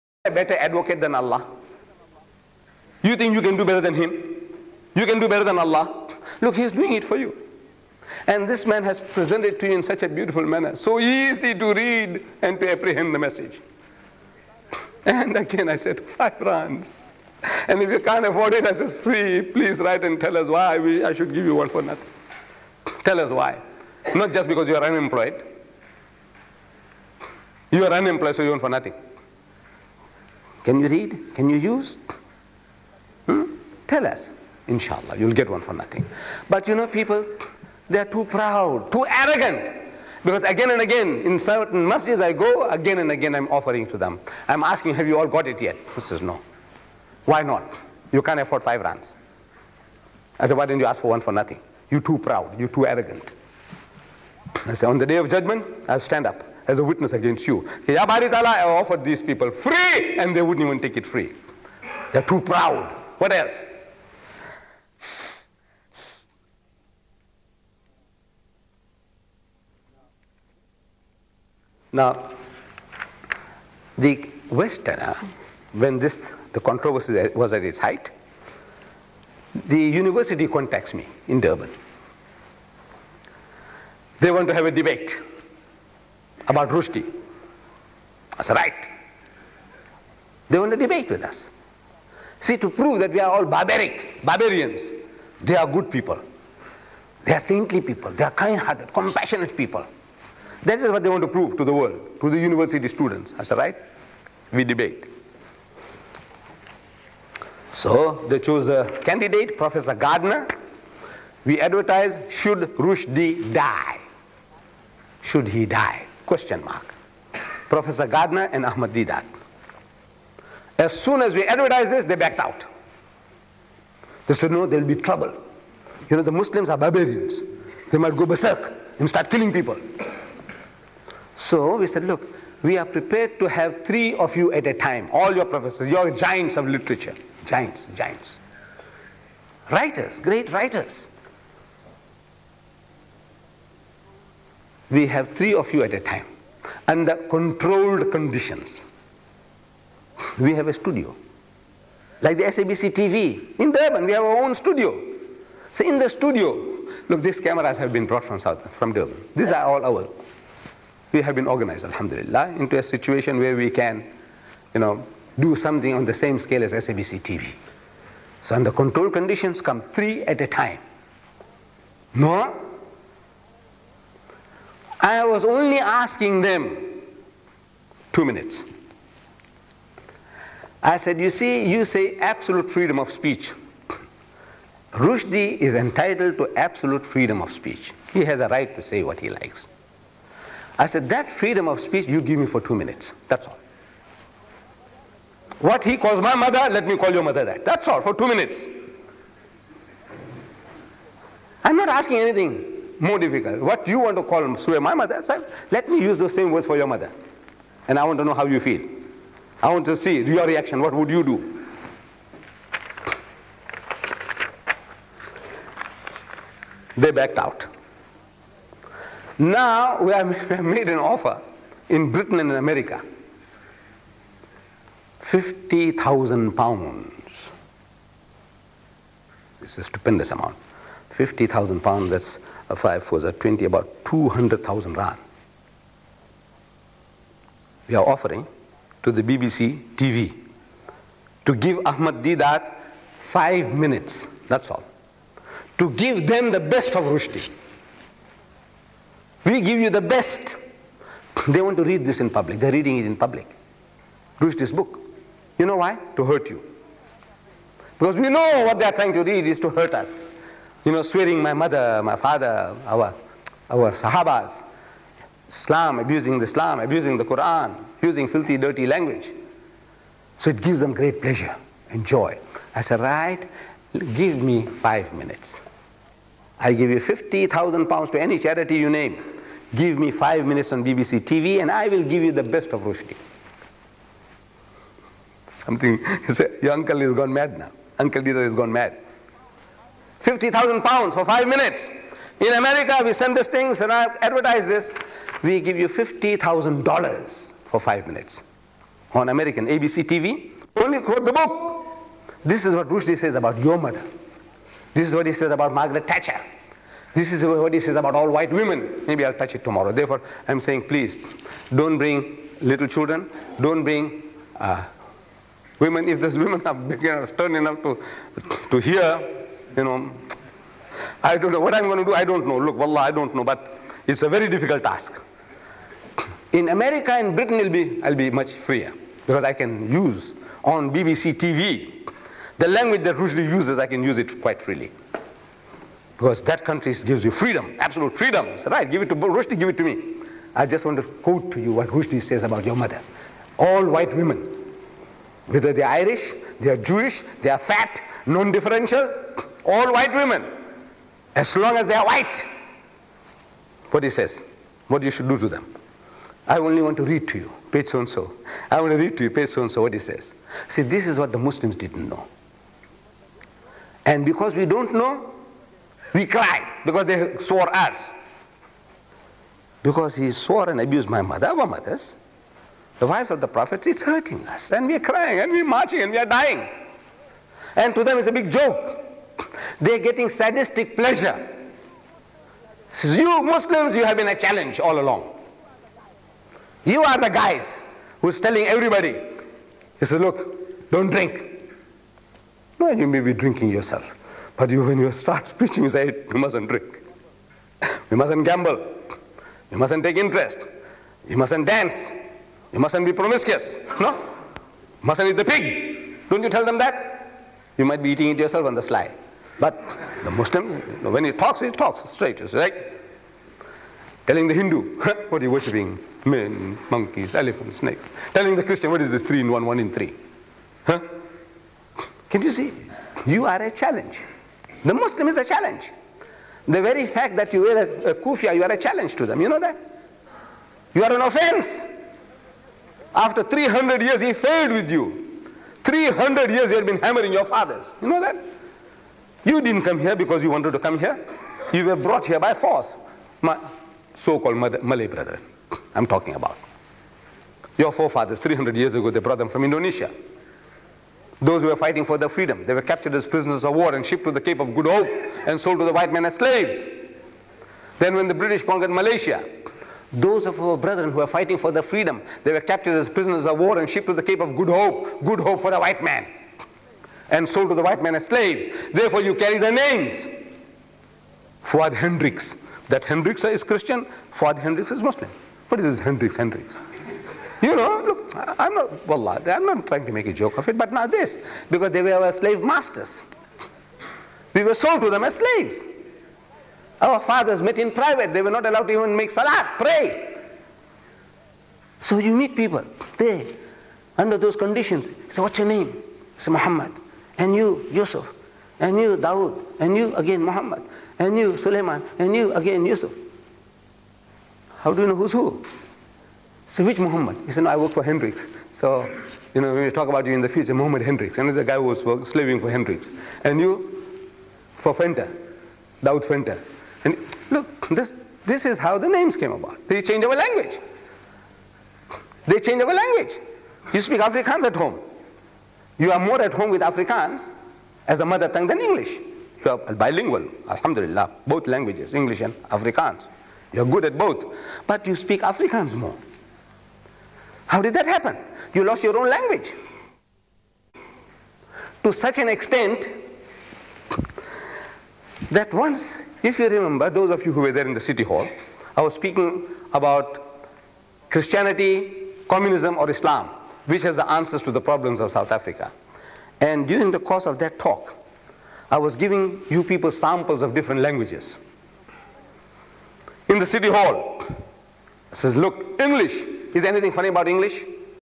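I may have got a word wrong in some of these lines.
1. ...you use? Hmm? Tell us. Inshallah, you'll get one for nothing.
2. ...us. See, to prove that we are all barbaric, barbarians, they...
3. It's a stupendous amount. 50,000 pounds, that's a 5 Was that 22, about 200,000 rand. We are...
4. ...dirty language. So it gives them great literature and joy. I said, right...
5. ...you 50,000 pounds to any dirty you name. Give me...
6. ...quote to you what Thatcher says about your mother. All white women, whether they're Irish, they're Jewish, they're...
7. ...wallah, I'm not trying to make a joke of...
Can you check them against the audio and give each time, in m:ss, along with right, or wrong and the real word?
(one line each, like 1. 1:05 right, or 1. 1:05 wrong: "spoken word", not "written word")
1. 0:31 right
2. 1:31 right
3. 3:49 wrong: "20", not "22"
4. 4:28 wrong: "pleasure", not "literature"
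5. 4:36 wrong: "charity", not "dirty"
6. 5:41 wrong: "Rushdie", not "Thatcher"
7. 7:59 right.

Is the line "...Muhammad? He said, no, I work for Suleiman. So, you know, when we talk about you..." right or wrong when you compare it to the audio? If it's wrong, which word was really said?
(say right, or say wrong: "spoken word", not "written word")
wrong: "Hendricks", not "Suleiman".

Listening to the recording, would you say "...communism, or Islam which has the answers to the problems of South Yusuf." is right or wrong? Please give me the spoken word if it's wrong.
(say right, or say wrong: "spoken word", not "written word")
wrong: "Africa", not "Yusuf".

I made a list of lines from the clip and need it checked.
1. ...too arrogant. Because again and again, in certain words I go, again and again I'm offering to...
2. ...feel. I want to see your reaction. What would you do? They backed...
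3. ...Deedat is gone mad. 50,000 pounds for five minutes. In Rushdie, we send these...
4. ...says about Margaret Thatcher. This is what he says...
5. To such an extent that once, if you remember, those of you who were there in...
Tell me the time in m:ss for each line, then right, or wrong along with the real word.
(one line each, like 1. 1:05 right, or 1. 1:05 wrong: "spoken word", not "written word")
1. 0:38 wrong: "masjids", not "words"
2. 3:28 right
3. 4:48 wrong: "America", not "Rushdie"
4. 5:05 right
5. 9:02 right.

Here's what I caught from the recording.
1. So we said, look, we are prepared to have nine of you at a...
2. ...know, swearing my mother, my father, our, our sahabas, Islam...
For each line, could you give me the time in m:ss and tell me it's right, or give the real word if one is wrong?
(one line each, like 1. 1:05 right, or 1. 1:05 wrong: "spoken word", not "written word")
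1. 2:11 wrong: "three", not "nine"
2. 4:20 right.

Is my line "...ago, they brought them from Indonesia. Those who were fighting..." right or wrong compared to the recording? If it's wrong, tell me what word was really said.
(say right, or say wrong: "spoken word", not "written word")
right.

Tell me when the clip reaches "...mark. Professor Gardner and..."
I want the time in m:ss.
1:56.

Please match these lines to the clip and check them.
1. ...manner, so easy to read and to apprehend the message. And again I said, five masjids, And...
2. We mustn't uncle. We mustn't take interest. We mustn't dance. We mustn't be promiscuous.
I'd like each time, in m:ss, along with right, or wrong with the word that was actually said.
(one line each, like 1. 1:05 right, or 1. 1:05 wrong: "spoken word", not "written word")
1. 0:10 wrong: "rands", not "masjids"
2. 6:38 wrong: "gamble", not "uncle".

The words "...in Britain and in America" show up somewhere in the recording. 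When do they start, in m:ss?
3:41.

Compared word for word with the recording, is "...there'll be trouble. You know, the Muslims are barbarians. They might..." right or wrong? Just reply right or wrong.
right.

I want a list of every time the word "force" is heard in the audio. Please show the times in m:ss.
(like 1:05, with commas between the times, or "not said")
7:22.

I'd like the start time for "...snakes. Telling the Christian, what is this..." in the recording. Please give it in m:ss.
6:57.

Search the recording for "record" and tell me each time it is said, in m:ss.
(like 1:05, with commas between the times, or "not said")
not said.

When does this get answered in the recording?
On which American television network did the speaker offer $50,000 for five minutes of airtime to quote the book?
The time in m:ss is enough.
4:59.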